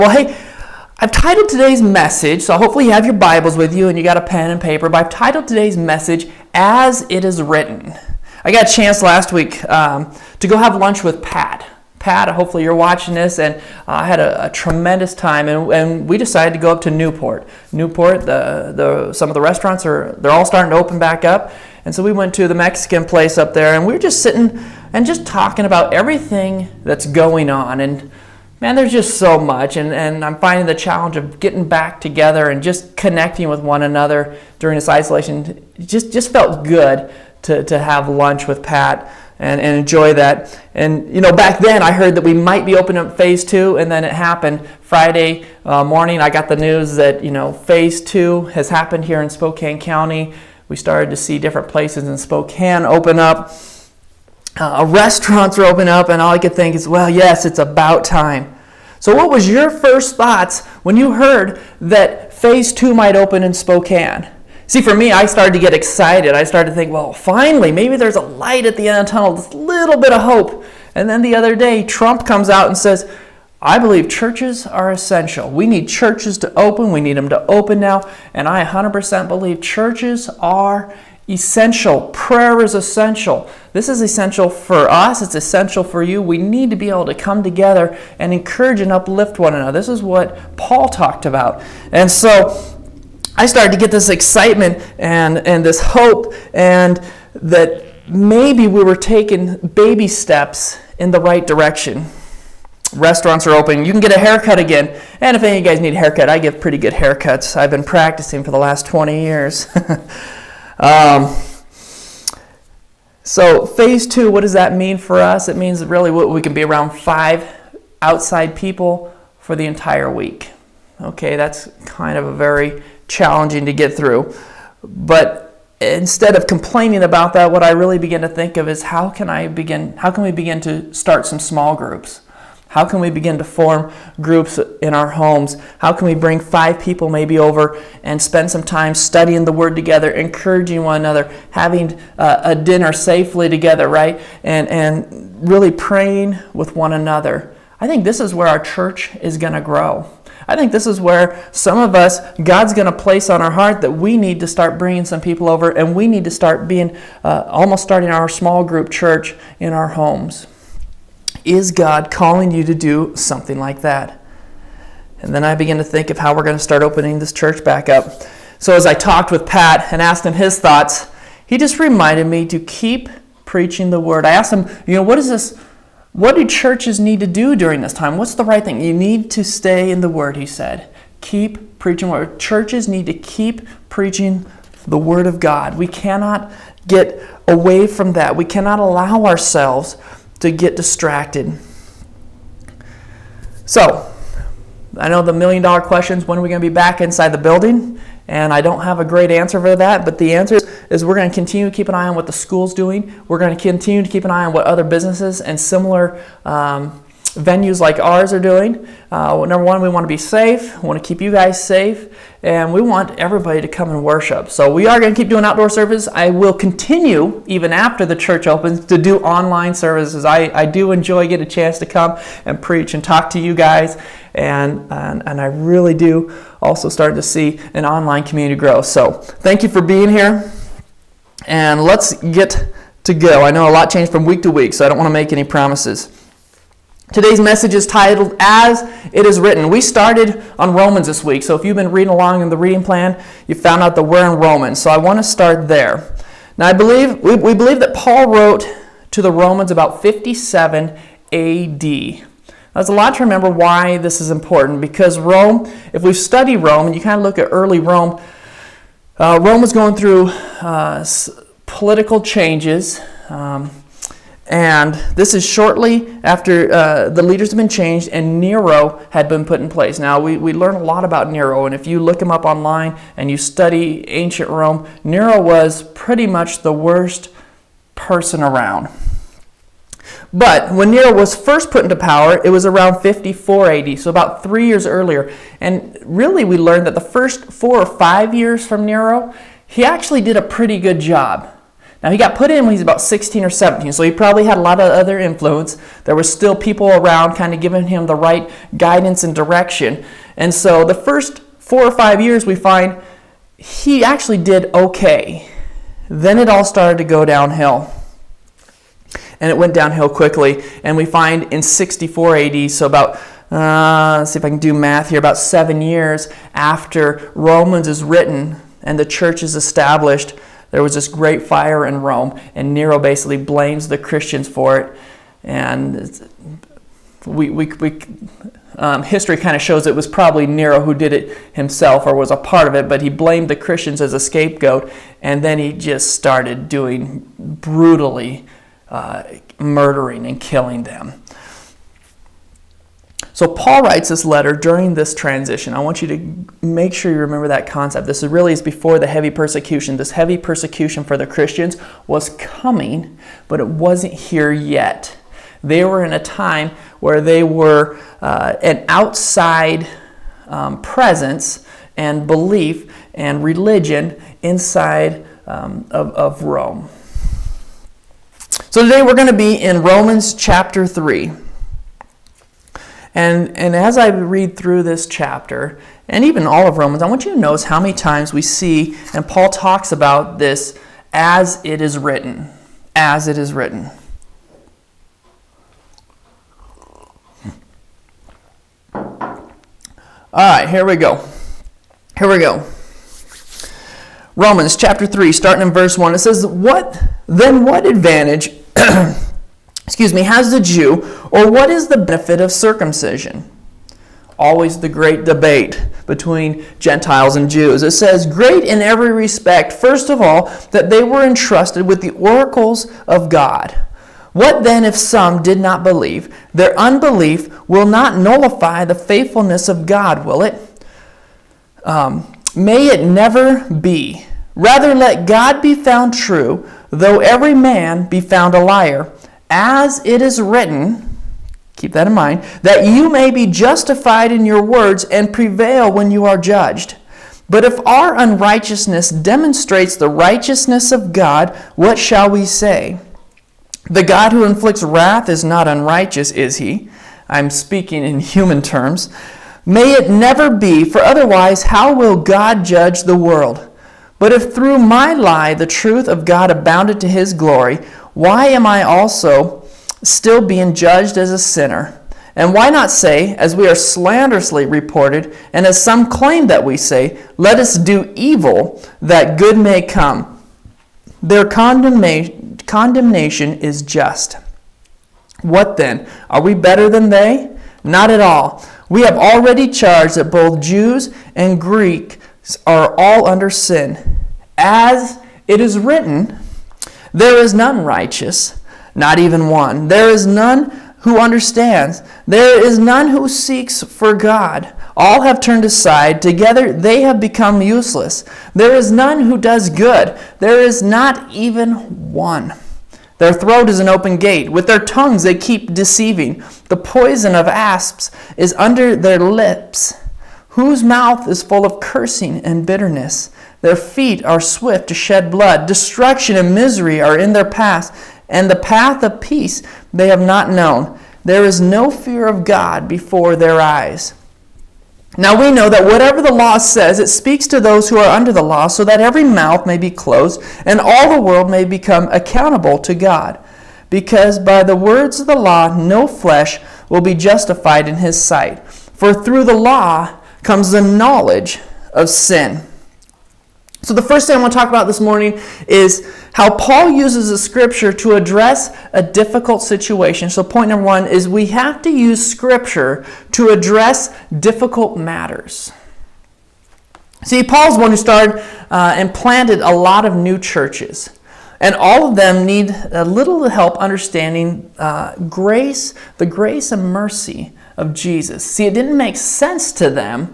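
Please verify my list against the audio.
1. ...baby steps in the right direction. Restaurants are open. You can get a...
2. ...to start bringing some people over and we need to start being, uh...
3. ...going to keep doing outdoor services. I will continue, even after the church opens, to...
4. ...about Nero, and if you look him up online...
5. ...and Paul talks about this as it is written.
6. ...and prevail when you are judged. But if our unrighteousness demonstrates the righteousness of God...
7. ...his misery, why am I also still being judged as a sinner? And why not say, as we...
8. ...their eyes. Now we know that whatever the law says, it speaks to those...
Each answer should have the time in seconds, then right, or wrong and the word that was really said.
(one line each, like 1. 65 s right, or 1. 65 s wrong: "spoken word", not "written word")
1. 99 s right
2. 154 s right
3. 214 s right
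4. 271 s right
5. 379 s right
6. 435 s right
7. 457 s wrong: "glory", not "misery"
8. 523 s right.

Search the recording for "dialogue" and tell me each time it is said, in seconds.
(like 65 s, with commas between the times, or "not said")
not said.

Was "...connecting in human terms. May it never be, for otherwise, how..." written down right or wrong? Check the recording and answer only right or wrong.
wrong.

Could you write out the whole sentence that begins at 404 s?
Always the great debate between Gentiles and Jews.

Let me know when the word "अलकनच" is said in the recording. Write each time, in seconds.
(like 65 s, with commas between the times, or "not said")
not said.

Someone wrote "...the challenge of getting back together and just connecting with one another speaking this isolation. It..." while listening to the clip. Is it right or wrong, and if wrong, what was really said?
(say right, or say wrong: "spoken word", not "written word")
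wrong: "during", not "speaking".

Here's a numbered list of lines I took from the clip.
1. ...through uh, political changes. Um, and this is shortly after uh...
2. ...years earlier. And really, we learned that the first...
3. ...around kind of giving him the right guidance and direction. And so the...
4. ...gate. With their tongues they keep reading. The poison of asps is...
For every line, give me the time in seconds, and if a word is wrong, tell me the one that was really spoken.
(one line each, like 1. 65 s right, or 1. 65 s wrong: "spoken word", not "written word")
1. 259 s right
2. 284 s right
3. 296 s right
4. 504 s wrong: "deceiving", not "reading".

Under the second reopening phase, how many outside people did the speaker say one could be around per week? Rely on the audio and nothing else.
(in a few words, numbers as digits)
5.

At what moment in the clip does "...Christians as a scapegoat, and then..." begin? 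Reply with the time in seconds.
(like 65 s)
333 s.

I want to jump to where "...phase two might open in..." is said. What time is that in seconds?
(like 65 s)
62 s.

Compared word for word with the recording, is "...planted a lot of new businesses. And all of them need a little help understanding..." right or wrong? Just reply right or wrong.
wrong.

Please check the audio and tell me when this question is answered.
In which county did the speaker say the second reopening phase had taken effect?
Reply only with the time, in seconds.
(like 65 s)
49 s.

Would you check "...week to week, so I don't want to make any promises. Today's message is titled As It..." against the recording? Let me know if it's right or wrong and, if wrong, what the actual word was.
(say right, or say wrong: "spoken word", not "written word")
right.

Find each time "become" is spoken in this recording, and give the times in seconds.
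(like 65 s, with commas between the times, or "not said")
497 s, 531 s.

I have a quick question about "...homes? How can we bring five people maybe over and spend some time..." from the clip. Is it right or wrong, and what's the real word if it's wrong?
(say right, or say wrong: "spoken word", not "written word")
right.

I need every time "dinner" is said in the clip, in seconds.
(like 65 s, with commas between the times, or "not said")
142 s.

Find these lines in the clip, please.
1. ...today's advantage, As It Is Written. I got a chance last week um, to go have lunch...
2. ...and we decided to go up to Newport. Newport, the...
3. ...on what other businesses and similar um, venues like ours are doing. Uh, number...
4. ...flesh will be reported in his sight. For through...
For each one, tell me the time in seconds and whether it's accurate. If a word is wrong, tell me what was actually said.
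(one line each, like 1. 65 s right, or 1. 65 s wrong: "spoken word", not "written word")
1. 5 s wrong: "message", not "advantage"
2. 15 s right
3. 204 s right
4. 536 s wrong: "justified", not "reported".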